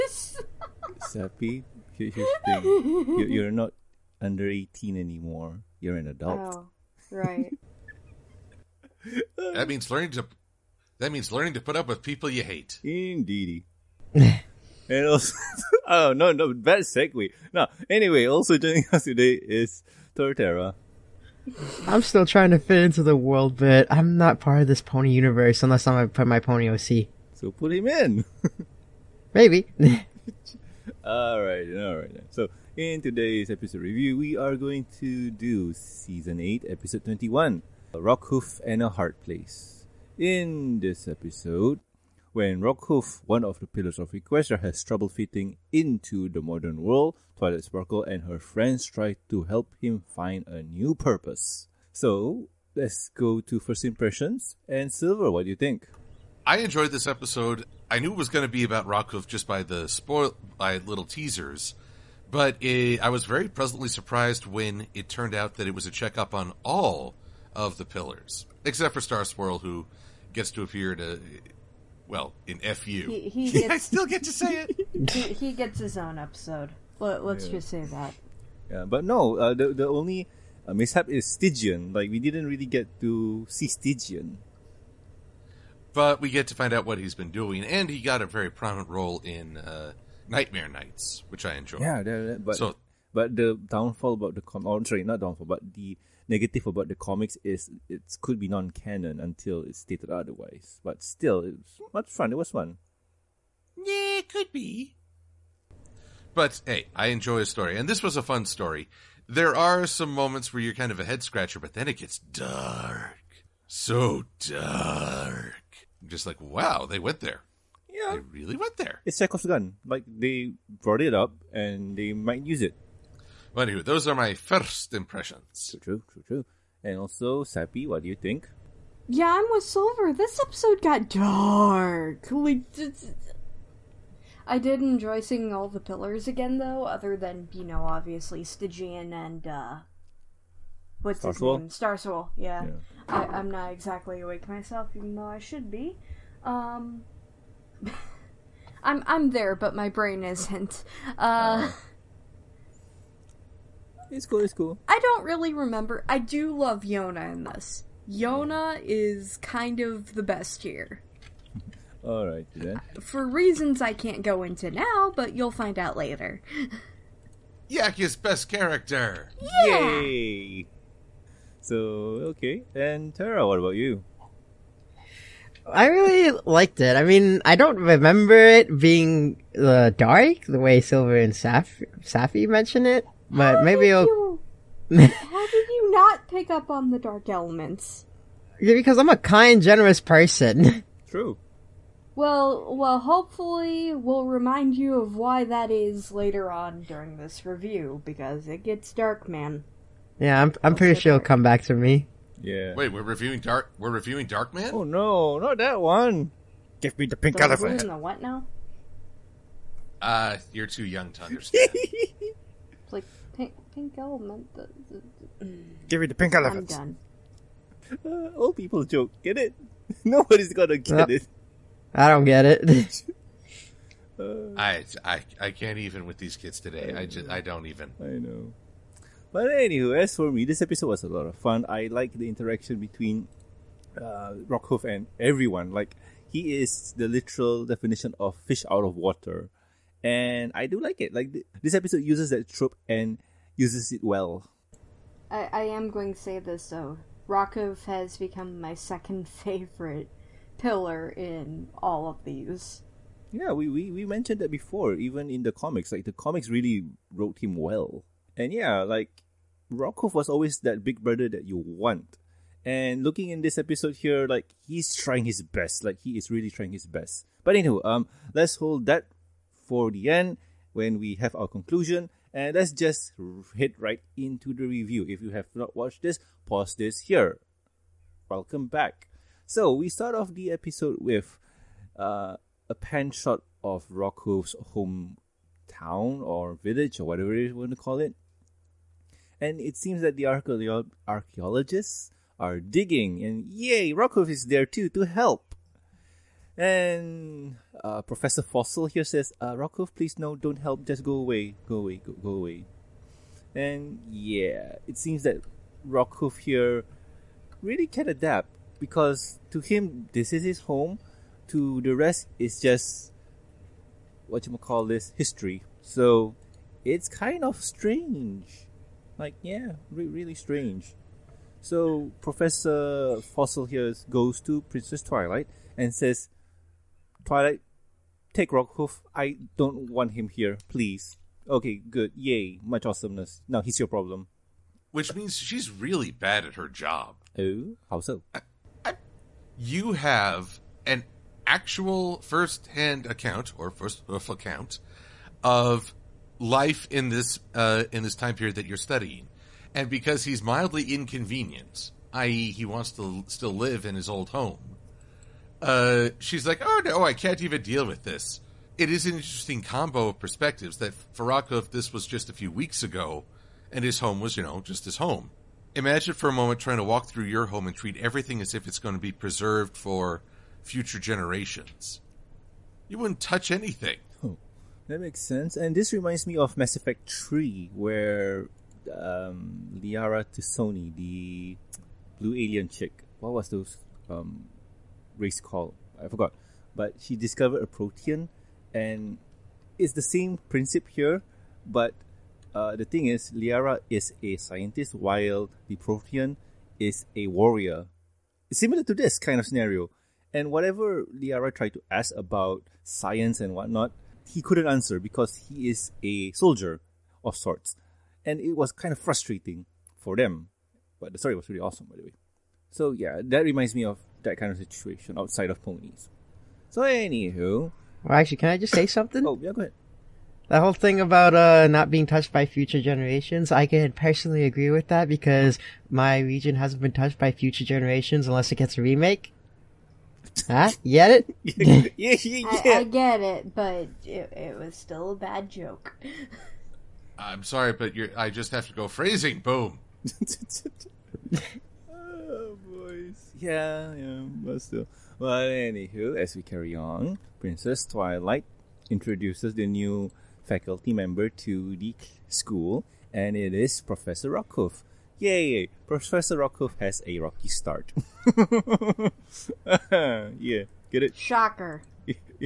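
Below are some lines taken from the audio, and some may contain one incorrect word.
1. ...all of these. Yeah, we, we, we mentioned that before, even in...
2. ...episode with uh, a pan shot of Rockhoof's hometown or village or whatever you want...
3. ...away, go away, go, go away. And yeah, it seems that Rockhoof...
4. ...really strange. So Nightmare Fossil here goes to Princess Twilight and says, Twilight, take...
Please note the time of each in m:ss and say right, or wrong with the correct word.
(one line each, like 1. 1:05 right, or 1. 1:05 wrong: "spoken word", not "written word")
1. 4:11 right
2. 4:40 right
3. 5:01 right
4. 5:20 wrong: "Professor", not "Nightmare".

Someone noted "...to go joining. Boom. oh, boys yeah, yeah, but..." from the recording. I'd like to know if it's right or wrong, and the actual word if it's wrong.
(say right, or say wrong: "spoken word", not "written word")
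wrong: "phrasing", not "joining".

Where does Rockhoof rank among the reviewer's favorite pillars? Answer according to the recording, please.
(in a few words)
Second.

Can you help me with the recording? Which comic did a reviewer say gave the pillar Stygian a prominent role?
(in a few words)
Nightmare Knights.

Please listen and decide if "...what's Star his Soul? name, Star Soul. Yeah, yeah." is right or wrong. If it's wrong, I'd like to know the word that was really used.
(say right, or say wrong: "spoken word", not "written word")
right.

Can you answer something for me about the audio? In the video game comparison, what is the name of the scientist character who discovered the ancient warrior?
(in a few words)
Liara T'Soni.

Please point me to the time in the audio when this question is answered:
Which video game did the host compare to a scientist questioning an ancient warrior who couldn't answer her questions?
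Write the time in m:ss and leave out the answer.
6:16.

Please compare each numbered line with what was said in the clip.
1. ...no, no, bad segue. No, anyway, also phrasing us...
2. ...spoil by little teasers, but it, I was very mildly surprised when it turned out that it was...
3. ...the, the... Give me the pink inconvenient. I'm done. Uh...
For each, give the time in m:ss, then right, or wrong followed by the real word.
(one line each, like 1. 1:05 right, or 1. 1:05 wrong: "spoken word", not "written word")
1. 0:16 wrong: "joining", not "phrasing"
2. 0:59 wrong: "pleasantly", not "mildly"
3. 3:34 wrong: "elephant", not "inconvenient".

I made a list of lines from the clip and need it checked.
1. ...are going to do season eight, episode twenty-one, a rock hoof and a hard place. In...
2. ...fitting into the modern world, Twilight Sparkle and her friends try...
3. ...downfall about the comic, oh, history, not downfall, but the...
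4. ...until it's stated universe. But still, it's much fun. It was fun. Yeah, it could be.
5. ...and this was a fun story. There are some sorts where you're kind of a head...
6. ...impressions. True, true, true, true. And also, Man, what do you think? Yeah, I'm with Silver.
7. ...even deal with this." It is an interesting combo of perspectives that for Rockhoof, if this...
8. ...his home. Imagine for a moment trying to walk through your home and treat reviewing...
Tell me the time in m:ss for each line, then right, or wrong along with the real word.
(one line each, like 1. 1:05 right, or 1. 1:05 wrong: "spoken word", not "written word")
1. 0:34 right
2. 0:45 right
3. 1:33 wrong: "sorry", not "history"
4. 1:39 wrong: "otherwise", not "universe"
5. 1:47 wrong: "moments", not "sorts"
6. 2:04 wrong: "Sappy", not "Man"
7. 5:57 right
8. 6:04 wrong: "everything", not "reviewing".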